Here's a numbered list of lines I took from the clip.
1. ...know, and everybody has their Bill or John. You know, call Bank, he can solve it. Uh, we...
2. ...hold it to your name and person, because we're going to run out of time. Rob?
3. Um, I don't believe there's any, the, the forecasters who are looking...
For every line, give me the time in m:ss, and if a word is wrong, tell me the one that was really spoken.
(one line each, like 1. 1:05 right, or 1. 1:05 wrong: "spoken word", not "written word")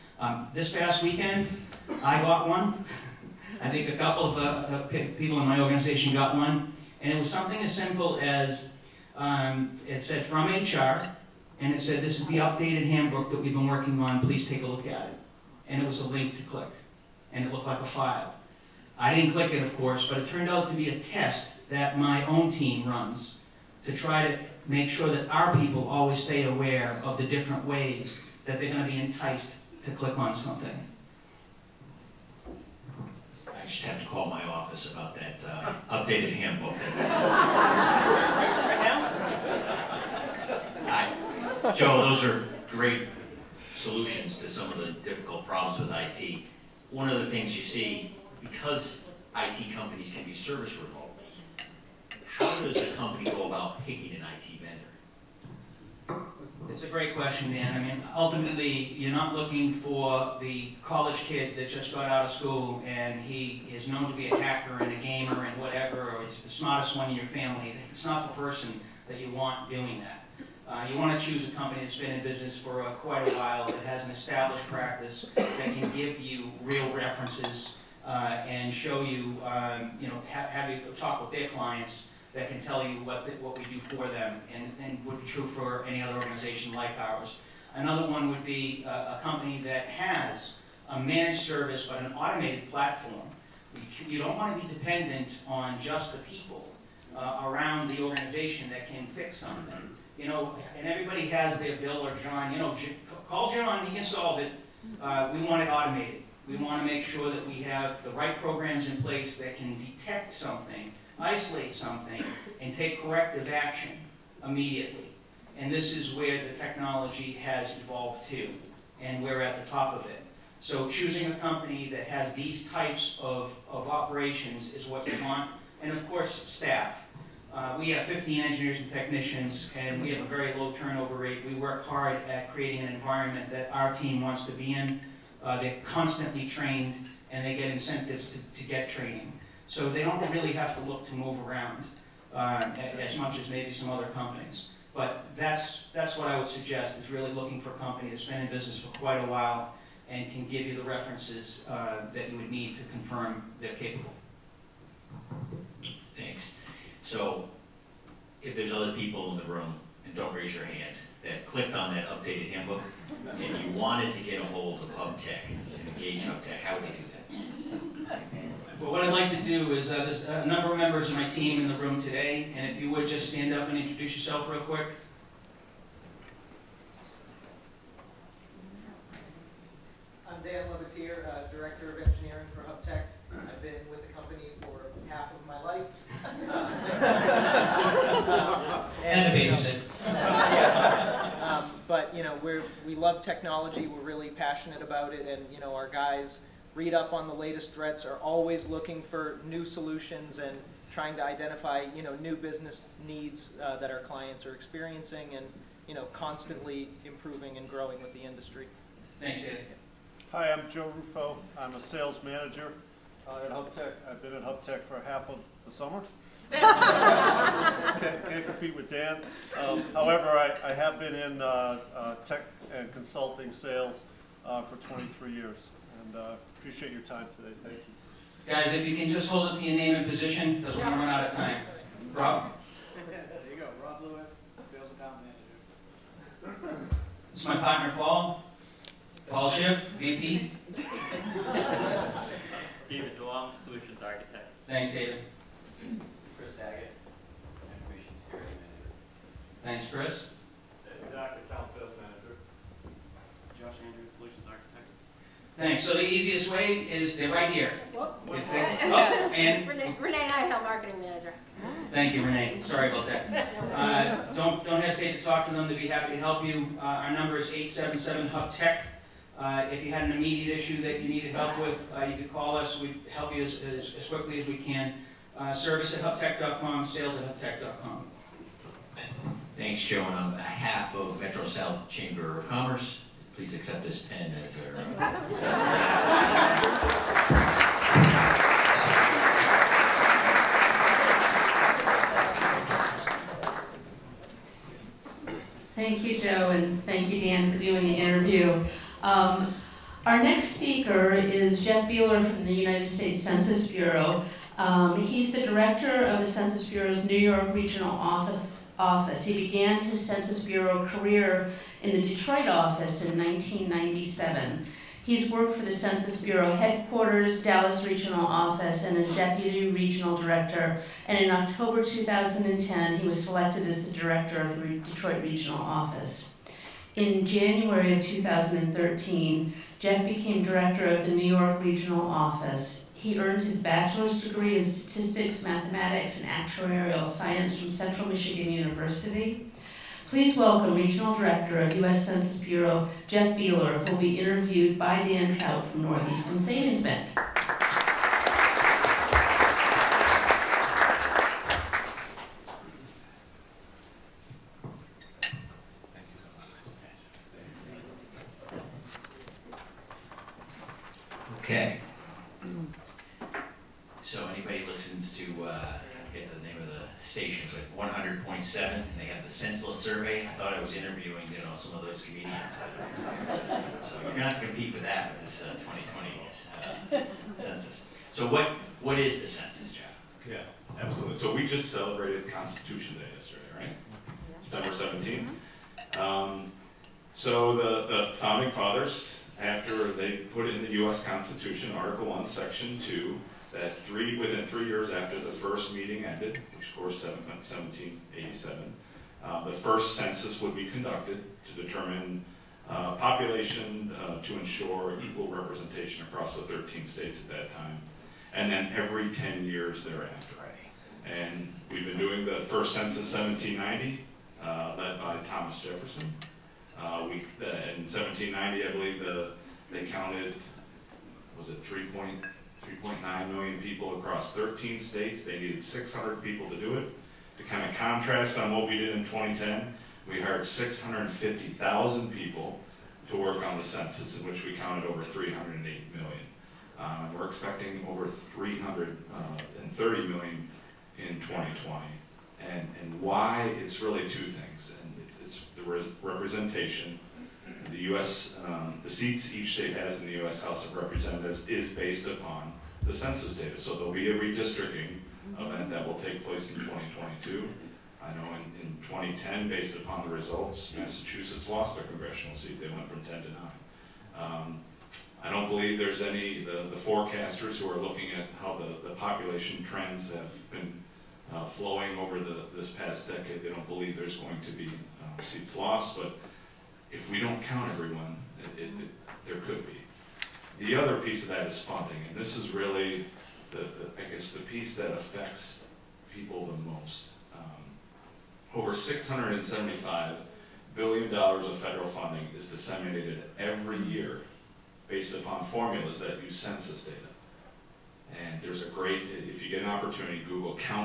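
1. 1:40 wrong: "John", not "Bank"
2. 3:49 wrong: "position", not "person"
3. 7:44 right.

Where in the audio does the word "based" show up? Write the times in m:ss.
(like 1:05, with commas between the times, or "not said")
7:31, 7:39, 8:14.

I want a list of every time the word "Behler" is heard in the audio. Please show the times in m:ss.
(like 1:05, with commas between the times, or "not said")
5:01, 5:43.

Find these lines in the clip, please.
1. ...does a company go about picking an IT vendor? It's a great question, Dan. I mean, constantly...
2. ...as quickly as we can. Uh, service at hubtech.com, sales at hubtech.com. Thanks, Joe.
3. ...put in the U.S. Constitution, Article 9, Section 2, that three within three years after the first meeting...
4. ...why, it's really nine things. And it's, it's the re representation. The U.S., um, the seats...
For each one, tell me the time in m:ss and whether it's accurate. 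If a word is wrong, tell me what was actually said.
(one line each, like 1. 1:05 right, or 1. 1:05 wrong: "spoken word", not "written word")
1. 0:52 wrong: "ultimately", not "constantly"
2. 4:33 right
3. 6:30 wrong: "1", not "9"
4. 7:23 wrong: "two", not "nine".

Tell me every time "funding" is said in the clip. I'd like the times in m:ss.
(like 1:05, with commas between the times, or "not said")
8:01, 8:11.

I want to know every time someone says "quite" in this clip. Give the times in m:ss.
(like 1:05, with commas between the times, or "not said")
1:12, 2:28.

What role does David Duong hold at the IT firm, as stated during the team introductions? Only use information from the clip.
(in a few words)
Solutions Architect.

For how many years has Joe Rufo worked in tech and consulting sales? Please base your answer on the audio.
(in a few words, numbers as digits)
23.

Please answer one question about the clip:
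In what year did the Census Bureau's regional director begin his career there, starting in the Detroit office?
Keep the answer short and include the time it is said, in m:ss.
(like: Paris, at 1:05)
1997, at 5:13.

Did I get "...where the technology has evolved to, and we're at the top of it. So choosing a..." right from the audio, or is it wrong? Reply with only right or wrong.
right.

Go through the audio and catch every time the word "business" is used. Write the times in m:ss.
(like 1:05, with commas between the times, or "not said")
1:12, 2:28, 3:22.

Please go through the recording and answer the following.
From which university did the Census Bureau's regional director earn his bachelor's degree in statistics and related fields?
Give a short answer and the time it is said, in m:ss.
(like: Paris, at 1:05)
Central Michigan University, at 5:37.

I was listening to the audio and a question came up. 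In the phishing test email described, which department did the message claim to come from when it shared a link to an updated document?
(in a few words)
HR.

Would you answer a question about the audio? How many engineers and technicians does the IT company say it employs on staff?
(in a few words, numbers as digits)
15.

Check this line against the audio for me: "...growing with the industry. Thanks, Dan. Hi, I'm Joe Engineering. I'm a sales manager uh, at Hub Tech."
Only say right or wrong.
wrong.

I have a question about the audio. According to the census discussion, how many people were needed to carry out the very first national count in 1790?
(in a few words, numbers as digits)
600.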